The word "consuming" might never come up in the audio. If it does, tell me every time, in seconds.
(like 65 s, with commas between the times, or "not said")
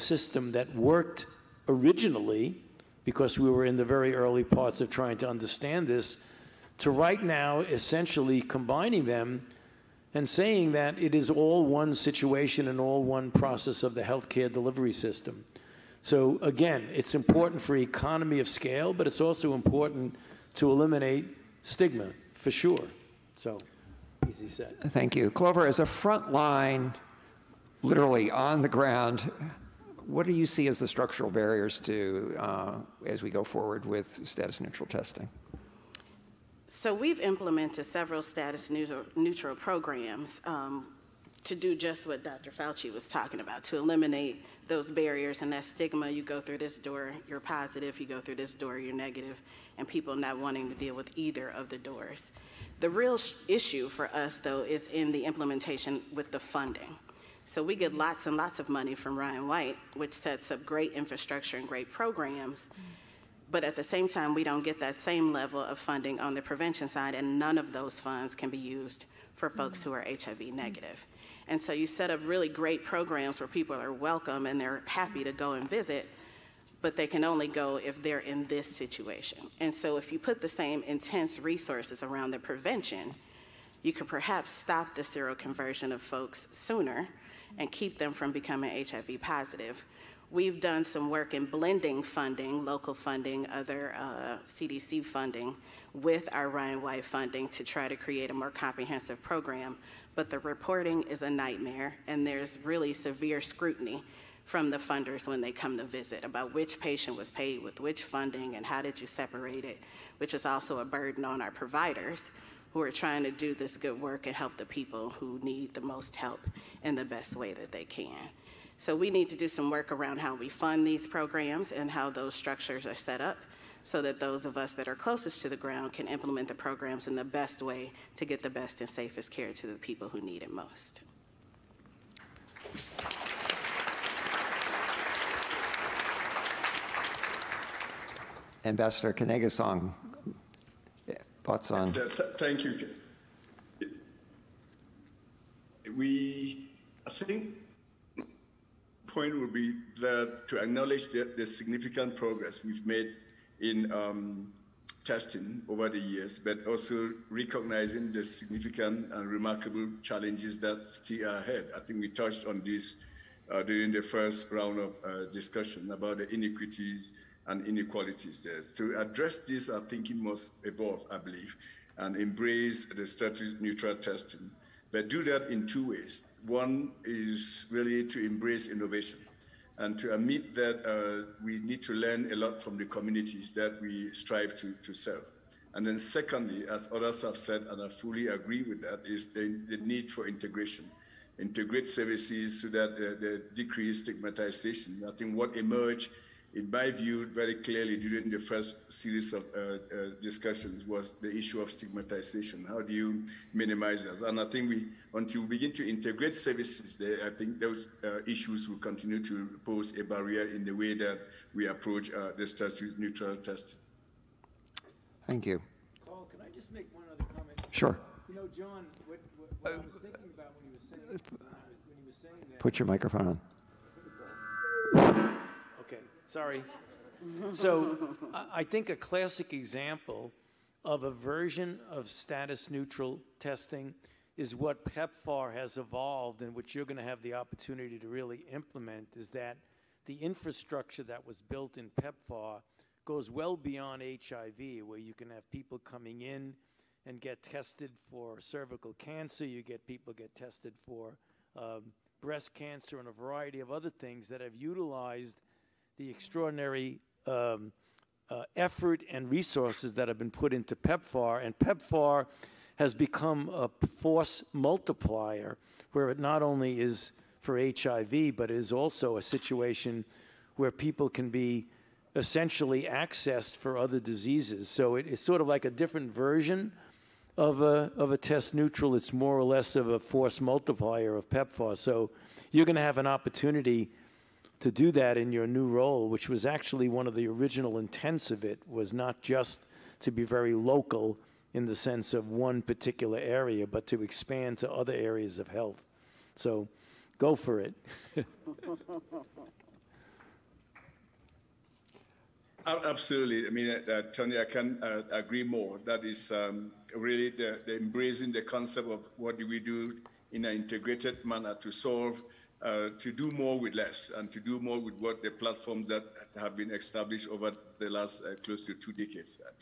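not said.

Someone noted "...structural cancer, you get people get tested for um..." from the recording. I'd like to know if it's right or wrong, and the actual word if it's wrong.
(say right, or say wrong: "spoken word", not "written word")
wrong: "cervical", not "structural".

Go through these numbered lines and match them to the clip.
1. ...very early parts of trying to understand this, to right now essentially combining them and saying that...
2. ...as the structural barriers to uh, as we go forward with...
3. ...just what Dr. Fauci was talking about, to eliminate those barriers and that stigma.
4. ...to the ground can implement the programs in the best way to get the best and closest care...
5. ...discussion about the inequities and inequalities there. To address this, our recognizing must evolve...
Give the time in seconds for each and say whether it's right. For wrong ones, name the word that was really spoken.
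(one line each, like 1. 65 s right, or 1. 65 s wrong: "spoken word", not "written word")
1. 3 s right
2. 30 s right
3. 41 s right
4. 125 s wrong: "safest", not "closest"
5. 165 s wrong: "thinking", not "recognizing".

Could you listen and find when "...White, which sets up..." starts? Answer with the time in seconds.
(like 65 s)
59 s.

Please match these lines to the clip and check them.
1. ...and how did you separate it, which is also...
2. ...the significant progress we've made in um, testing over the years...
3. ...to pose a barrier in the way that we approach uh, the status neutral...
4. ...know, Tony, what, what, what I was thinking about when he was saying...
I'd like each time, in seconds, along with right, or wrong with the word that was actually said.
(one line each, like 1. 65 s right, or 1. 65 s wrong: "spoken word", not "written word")
1. 108 s right
2. 151 s right
3. 209 s right
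4. 218 s wrong: "John", not "Tony".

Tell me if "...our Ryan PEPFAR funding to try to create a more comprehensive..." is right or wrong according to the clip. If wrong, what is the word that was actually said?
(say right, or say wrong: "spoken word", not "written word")
wrong: "White", not "PEPFAR".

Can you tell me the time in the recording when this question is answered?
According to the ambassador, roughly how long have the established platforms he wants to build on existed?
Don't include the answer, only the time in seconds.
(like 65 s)
318 s.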